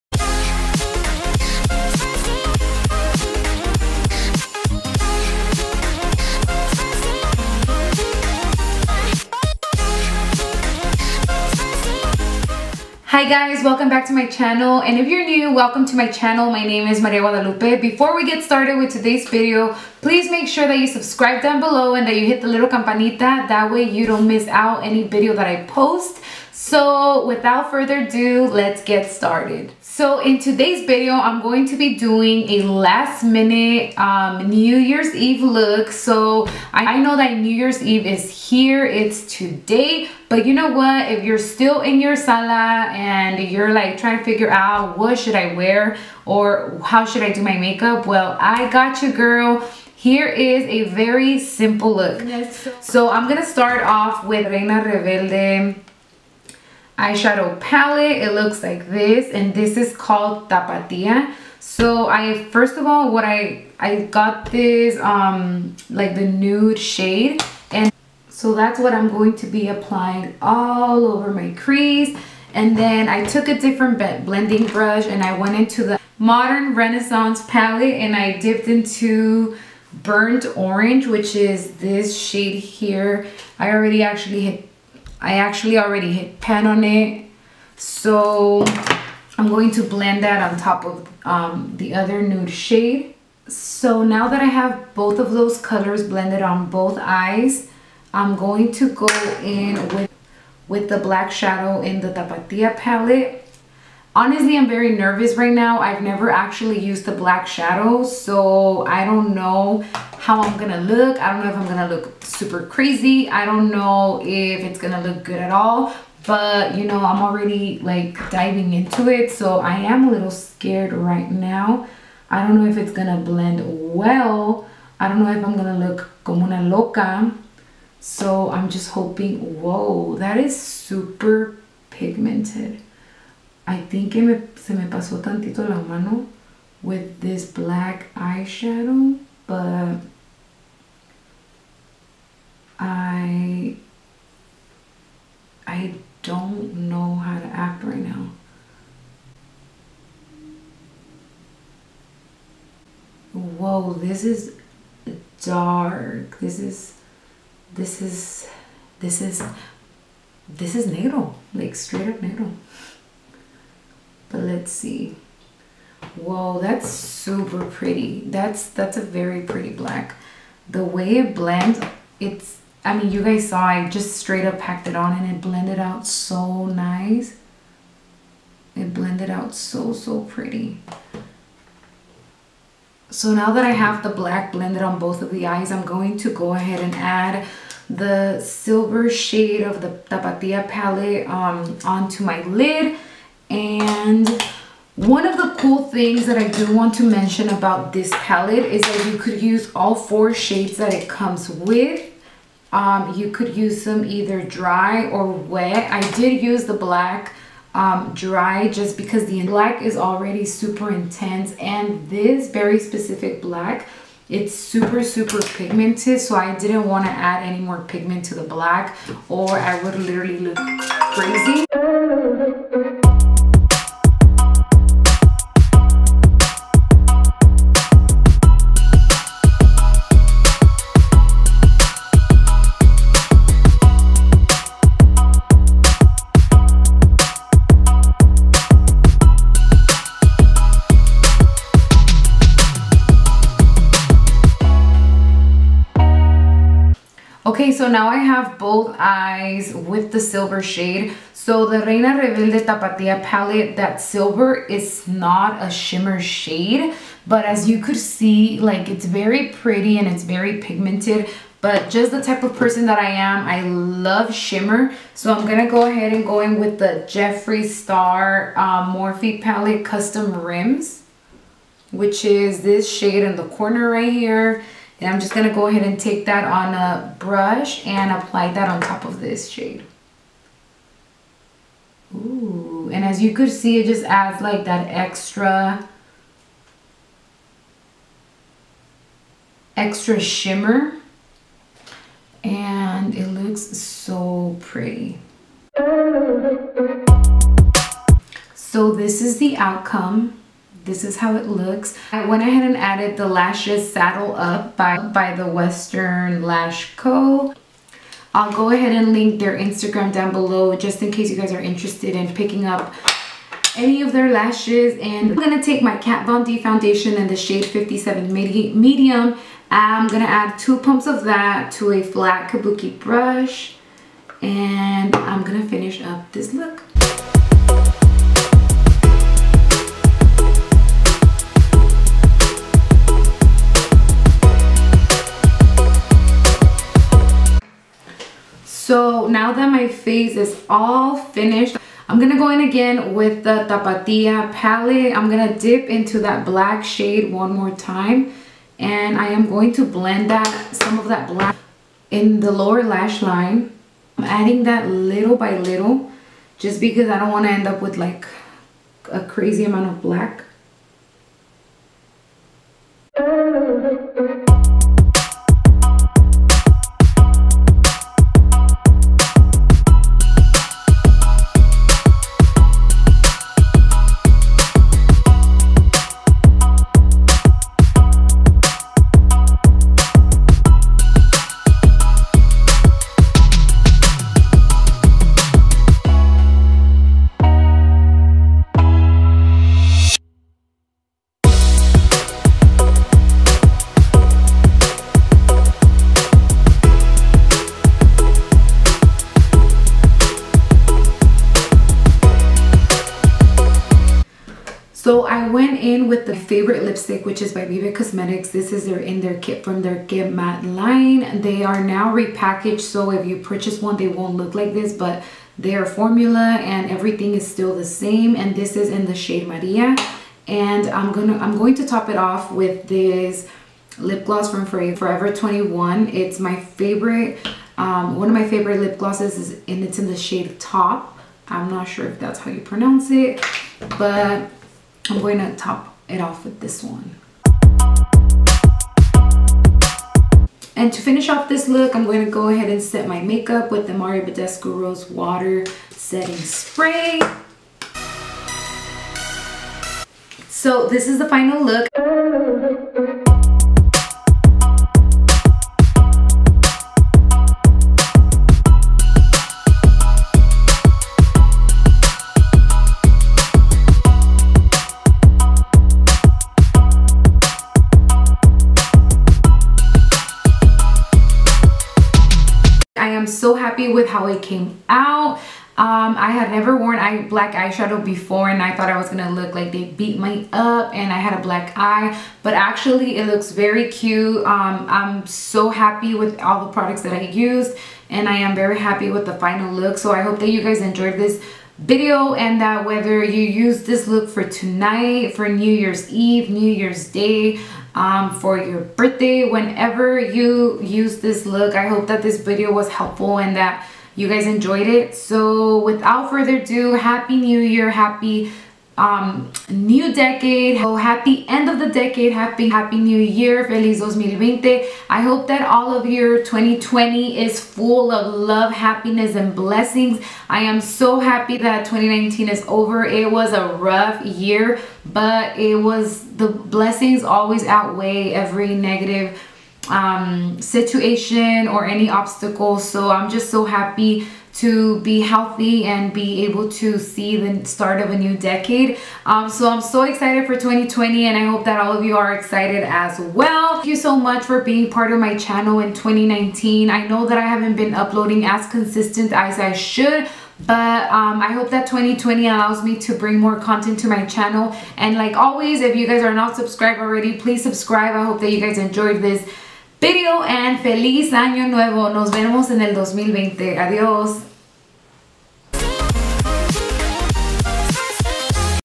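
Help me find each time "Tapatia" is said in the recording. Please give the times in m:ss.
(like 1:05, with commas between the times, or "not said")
1:00, 1:42, 3:10, 4:12, 5:43.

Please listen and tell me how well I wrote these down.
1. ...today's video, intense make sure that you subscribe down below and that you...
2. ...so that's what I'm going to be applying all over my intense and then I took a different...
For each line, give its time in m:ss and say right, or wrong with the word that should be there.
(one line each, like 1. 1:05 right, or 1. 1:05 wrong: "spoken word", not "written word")
1. 0:18 wrong: "please", not "intense"
2. 1:08 wrong: "crease", not "intense".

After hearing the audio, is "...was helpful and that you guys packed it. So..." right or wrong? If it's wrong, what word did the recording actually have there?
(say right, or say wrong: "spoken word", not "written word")
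wrong: "enjoyed", not "packed".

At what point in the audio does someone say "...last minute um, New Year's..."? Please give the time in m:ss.
0:32.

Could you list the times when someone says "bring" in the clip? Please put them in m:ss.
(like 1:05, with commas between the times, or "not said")
9:13.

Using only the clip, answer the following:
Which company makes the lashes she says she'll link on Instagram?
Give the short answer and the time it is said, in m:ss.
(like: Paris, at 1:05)
Western Lash Co., at 5:05.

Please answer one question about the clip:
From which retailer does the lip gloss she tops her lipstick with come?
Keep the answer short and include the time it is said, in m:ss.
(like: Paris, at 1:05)
Forever 21, at 7:04.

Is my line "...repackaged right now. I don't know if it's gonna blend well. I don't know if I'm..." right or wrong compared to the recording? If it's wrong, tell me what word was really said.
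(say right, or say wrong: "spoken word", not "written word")
wrong: "scared", not "repackaged".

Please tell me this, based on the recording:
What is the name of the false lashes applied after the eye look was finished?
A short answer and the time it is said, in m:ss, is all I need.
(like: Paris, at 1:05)
Saddle Up, at 5:03.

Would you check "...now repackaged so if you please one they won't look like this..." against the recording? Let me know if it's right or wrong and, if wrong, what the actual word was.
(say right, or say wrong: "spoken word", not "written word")
wrong: "purchase", not "please".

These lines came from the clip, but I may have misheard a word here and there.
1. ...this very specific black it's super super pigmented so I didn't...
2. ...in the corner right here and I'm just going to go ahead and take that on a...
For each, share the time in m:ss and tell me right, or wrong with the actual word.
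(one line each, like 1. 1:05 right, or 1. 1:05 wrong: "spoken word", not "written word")
1. 3:32 right
2. 4:33 right.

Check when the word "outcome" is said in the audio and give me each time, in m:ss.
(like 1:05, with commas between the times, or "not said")
4:59.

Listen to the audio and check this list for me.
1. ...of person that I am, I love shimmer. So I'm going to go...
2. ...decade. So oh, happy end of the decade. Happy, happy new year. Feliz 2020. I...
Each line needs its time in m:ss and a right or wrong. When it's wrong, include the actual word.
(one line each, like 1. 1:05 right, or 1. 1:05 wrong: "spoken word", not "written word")
1. 4:22 right
2. 8:30 right.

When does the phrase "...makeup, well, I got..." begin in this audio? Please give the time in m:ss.
0:47.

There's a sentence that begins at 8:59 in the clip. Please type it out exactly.
Um, so I'm so excited for 2020 and I hope that all of you are excited as well.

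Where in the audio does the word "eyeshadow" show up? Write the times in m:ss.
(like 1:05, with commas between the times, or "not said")
0:57, 2:18, 7:57.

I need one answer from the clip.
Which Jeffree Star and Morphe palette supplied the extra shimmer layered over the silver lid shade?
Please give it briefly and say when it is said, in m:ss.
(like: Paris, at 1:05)
Custom Rims, at 4:29.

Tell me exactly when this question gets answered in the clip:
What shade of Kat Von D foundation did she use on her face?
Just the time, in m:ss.
5:17.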